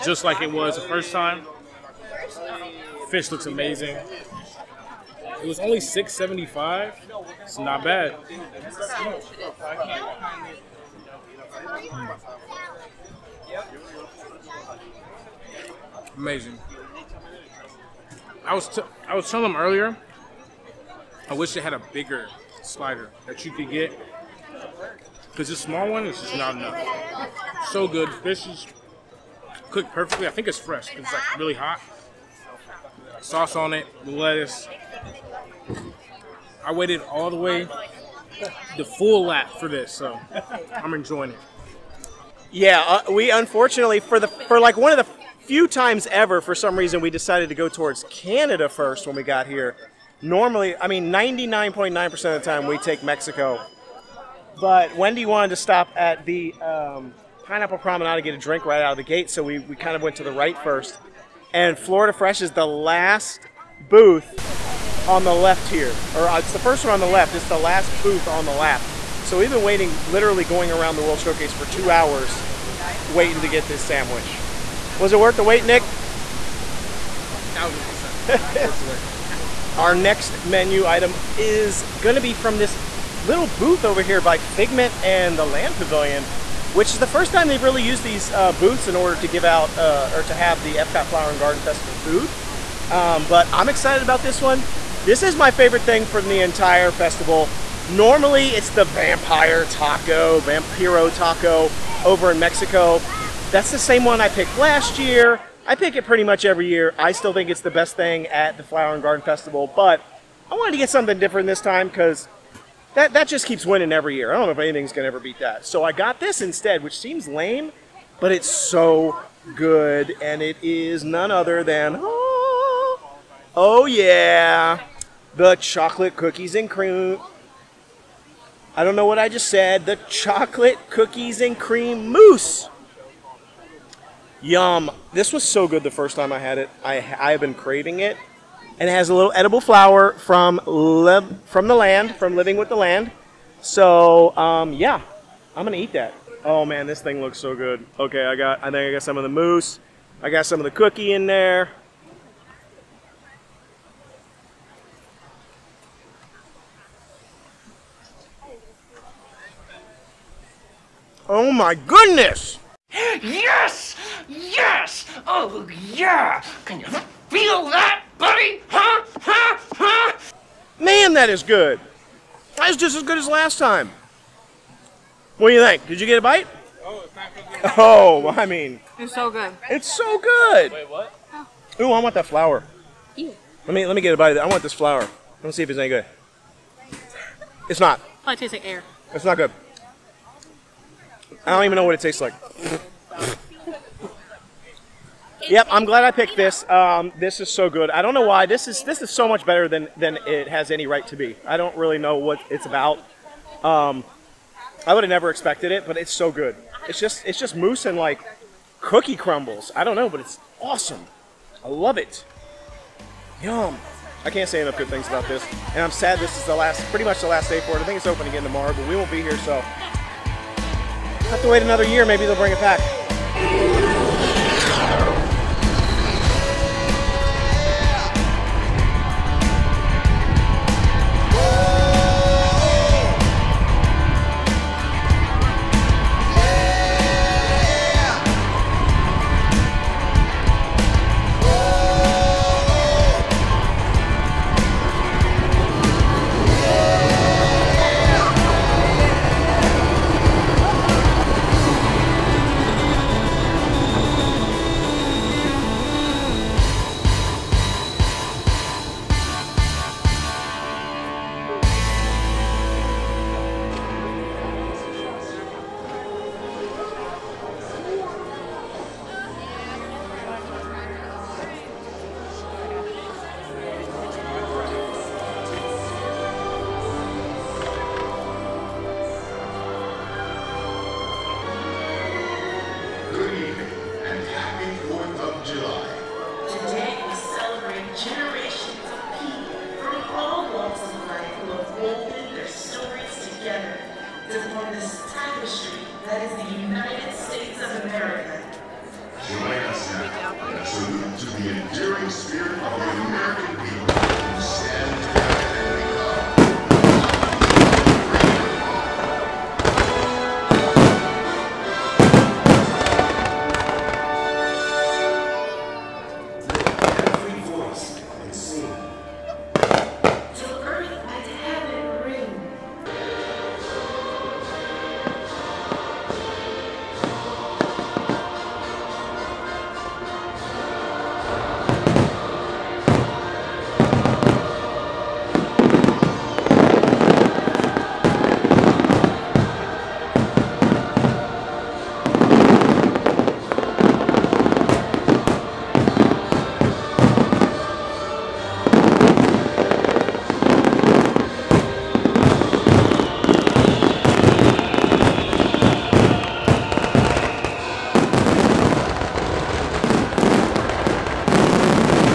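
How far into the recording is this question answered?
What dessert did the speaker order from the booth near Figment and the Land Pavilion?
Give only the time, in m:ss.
2:10.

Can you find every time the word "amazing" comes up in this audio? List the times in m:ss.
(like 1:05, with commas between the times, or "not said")
0:03, 0:16.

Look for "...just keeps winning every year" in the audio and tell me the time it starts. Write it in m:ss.
1:53.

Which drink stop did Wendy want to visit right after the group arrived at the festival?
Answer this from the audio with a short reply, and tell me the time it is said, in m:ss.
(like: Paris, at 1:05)
Pineapple Promenade, at 0:57.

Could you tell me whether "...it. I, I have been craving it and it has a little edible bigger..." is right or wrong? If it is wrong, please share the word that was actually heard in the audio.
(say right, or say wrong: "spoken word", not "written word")
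wrong: "flower", not "bigger".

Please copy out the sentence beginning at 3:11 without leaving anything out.
I don't even know what it tastes like.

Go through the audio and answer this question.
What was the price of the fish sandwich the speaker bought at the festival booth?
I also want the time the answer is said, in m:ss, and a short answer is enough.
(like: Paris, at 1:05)
6.75, at 0:05.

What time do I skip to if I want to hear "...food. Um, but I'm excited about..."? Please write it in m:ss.
1:31.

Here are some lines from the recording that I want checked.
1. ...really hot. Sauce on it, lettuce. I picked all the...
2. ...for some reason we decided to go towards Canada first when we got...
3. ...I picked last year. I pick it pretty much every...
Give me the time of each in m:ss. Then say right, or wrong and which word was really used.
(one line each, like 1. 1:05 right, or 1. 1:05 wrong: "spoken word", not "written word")
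1. 0:31 wrong: "waited", not "picked"
2. 0:46 right
3. 1:44 right.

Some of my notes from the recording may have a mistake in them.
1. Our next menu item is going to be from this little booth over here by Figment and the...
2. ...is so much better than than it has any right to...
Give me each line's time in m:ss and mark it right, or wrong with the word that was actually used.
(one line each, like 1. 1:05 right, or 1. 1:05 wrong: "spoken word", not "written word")
1. 1:19 right
2. 3:19 right.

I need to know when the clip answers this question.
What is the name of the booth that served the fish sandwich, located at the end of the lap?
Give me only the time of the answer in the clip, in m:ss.
1:01.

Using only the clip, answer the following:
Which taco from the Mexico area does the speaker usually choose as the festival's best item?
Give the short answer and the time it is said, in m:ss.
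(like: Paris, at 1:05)
Vampiro taco, at 1:40.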